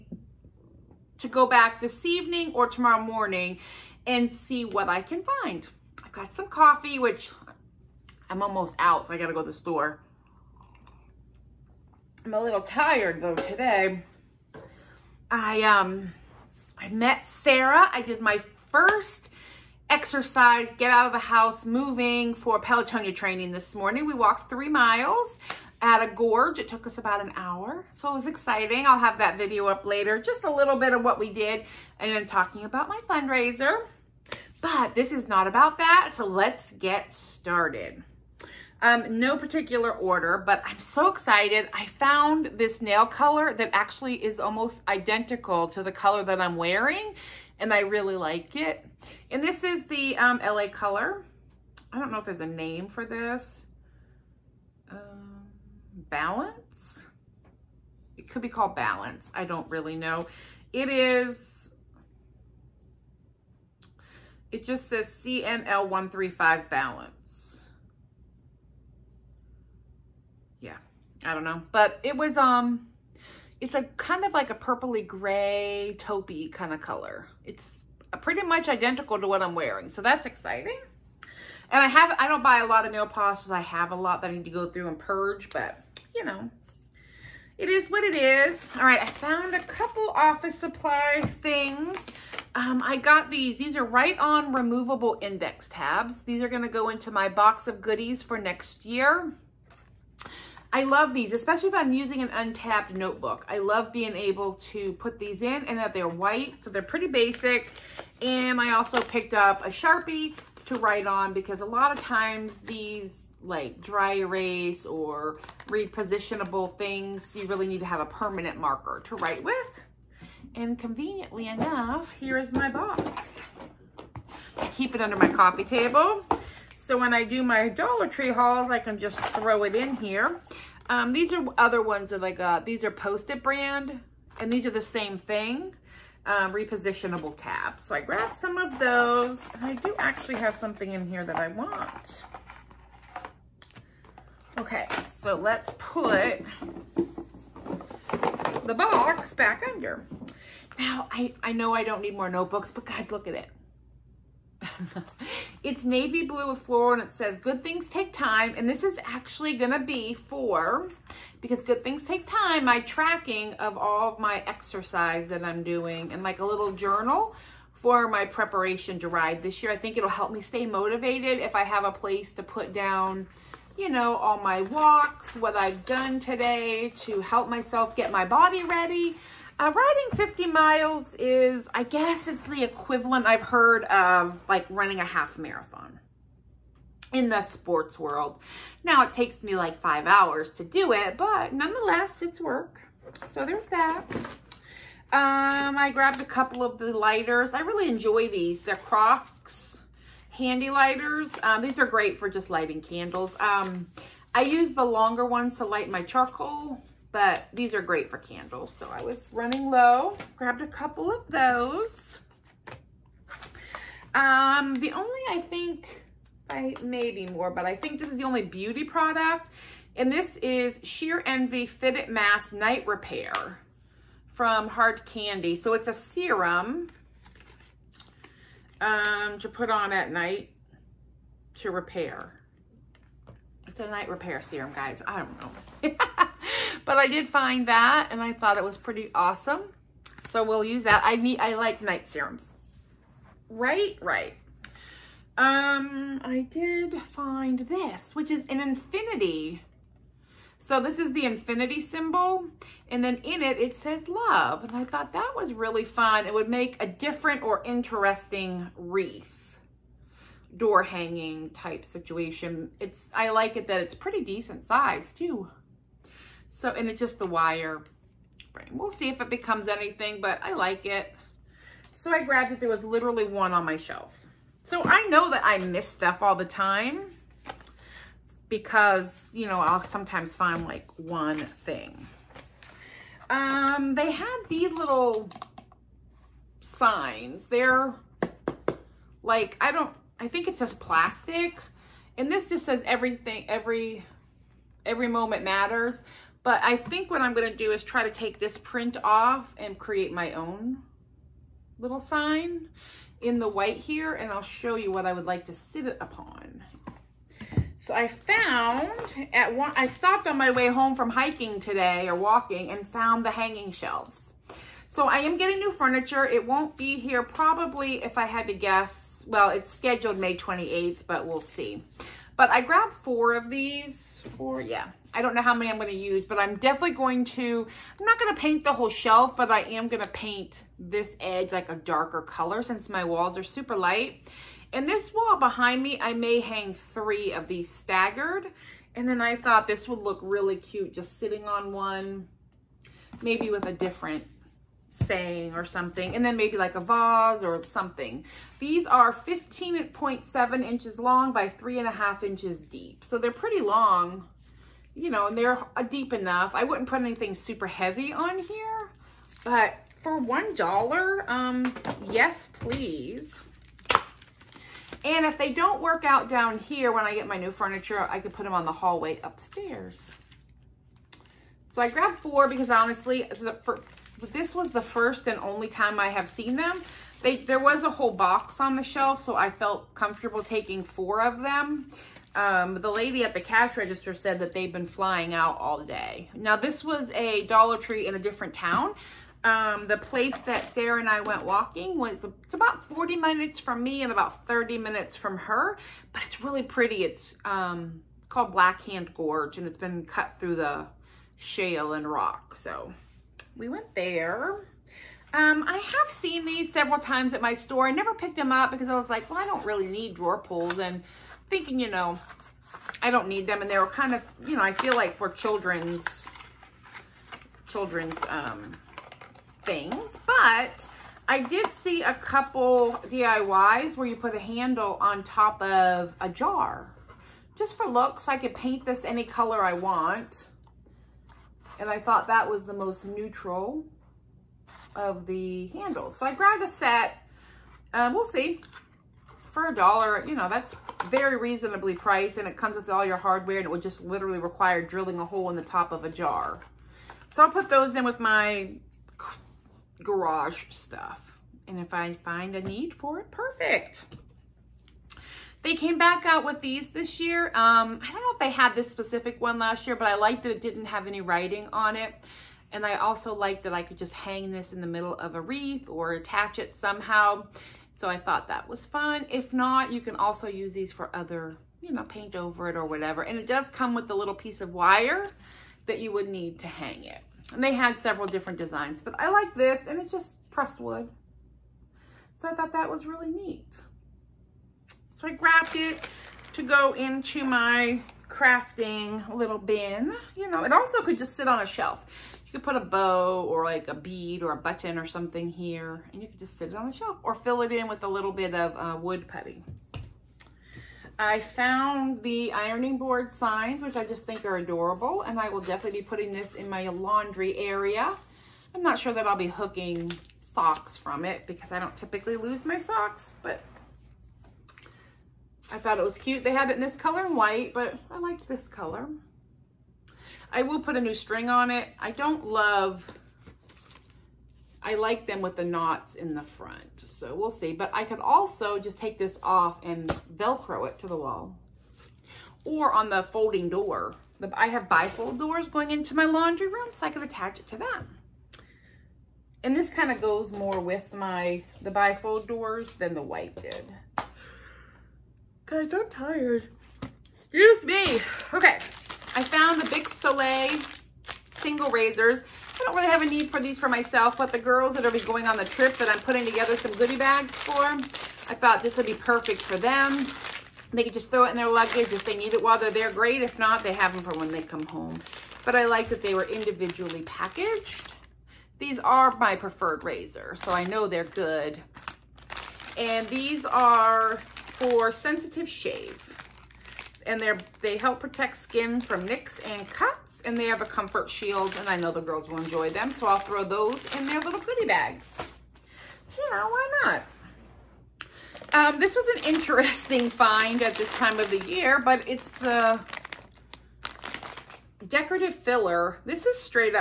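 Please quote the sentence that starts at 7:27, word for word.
So I'll put those in with my garage stuff.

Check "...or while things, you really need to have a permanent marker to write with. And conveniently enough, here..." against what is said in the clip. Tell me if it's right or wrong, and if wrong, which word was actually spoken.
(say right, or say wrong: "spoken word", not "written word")
wrong: "repositionable", not "while".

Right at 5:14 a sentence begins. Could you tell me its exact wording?
So I am getting new furniture.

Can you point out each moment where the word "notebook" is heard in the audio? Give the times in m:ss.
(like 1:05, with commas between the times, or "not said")
1:42, 2:32.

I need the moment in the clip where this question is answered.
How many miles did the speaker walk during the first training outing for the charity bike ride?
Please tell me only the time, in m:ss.
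0:24.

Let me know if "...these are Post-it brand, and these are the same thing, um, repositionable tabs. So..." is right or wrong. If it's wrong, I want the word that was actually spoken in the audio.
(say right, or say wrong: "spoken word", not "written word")
right.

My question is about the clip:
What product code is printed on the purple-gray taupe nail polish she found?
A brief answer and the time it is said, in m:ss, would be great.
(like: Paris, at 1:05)
CML135, at 1:05.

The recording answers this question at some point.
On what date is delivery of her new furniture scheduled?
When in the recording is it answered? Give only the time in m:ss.
5:20.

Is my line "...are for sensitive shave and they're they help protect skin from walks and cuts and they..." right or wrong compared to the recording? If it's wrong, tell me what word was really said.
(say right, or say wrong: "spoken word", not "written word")
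wrong: "nicks", not "walks".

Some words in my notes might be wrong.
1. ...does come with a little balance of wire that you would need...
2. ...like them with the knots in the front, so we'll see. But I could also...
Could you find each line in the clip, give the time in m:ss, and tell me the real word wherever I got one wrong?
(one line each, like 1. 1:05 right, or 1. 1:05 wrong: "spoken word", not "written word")
1. 7:53 wrong: "piece", not "balance"
2. 8:44 right.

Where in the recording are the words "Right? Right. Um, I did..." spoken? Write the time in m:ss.
4:03.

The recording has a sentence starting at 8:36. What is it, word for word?
They had it in this color and white, but I liked this color.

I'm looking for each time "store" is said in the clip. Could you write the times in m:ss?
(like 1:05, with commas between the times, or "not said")
0:09, 6:47.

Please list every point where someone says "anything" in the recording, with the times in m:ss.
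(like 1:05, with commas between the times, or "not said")
4:29, 5:57.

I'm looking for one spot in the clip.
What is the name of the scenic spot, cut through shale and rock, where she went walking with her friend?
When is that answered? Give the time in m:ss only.
6:38.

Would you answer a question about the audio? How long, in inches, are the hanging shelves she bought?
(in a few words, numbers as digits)
15.7 inches.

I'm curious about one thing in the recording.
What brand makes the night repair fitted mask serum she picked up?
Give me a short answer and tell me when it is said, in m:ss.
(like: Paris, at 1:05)
Hard Candy, at 3:44.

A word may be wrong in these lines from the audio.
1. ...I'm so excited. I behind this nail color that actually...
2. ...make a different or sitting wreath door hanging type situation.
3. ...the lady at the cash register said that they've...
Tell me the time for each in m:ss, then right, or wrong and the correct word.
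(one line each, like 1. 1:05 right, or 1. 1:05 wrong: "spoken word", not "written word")
1. 0:40 wrong: "found", not "behind"
2. 4:16 wrong: "interesting", not "sitting"
3. 6:22 right.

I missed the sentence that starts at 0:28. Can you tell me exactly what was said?
I'll have that video up later.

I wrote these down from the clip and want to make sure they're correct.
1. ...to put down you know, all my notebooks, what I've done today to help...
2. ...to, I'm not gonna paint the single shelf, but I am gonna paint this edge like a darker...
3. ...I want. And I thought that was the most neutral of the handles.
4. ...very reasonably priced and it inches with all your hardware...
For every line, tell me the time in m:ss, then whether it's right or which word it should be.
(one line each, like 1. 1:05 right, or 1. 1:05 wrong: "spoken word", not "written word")
1. 2:52 wrong: "walks", not "notebooks"
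2. 5:27 wrong: "whole", not "single"
3. 7:09 right
4. 7:21 wrong: "comes", not "inches".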